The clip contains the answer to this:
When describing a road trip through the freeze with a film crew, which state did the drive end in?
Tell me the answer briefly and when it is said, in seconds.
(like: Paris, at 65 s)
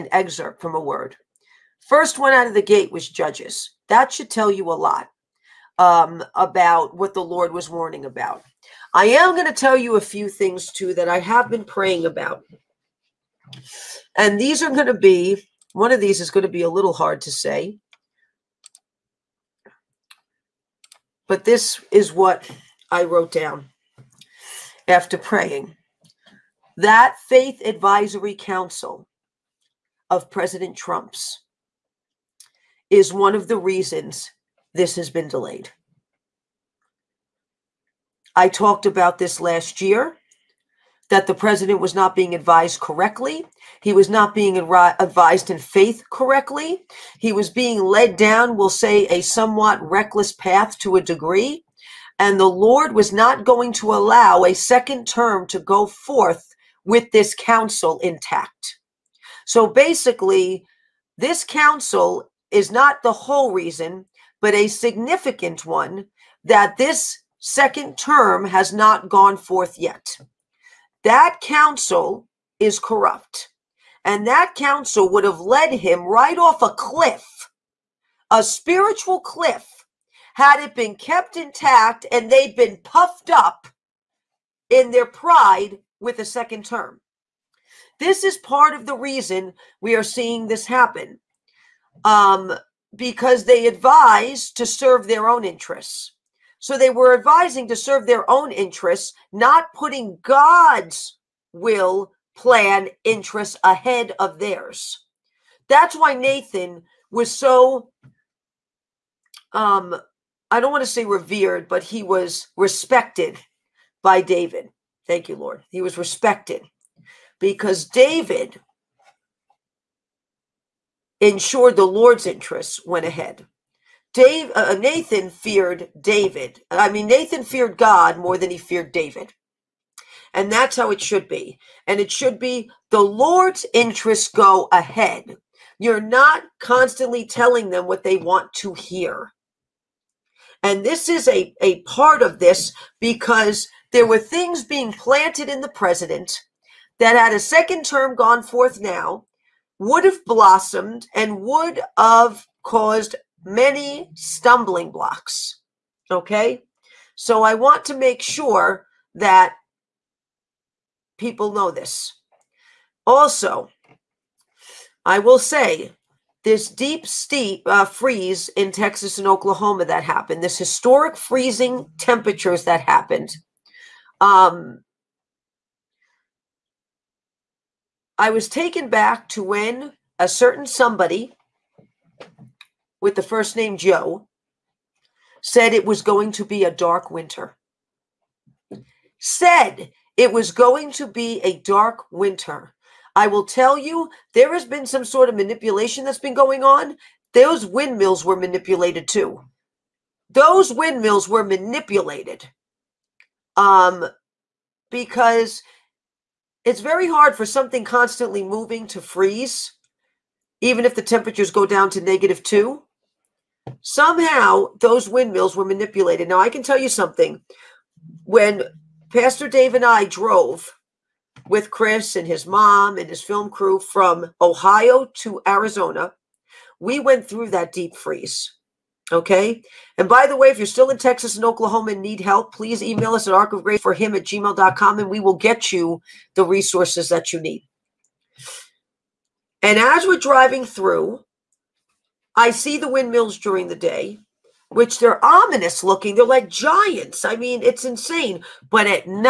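Arizona, at 225 s.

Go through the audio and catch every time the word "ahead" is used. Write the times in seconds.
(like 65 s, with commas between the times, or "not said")
103 s, 123 s, 134 s.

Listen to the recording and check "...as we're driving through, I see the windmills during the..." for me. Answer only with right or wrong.
right.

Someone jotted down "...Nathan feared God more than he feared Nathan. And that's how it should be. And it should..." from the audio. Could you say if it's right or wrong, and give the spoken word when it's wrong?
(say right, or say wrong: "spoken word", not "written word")
wrong: "David", not "Nathan".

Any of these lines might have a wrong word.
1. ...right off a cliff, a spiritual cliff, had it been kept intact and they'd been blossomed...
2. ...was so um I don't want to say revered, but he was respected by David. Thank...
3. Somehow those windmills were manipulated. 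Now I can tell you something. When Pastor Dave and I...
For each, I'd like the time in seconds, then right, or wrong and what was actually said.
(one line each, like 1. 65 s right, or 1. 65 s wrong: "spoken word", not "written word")
1. 76 s wrong: "puffed", not "blossomed"
2. 107 s right
3. 213 s right.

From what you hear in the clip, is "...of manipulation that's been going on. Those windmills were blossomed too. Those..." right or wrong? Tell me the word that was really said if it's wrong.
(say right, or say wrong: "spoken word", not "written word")
wrong: "manipulated", not "blossomed".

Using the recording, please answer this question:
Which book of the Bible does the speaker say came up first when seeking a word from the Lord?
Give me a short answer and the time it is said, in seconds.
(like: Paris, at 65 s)
Judges, at 3 s.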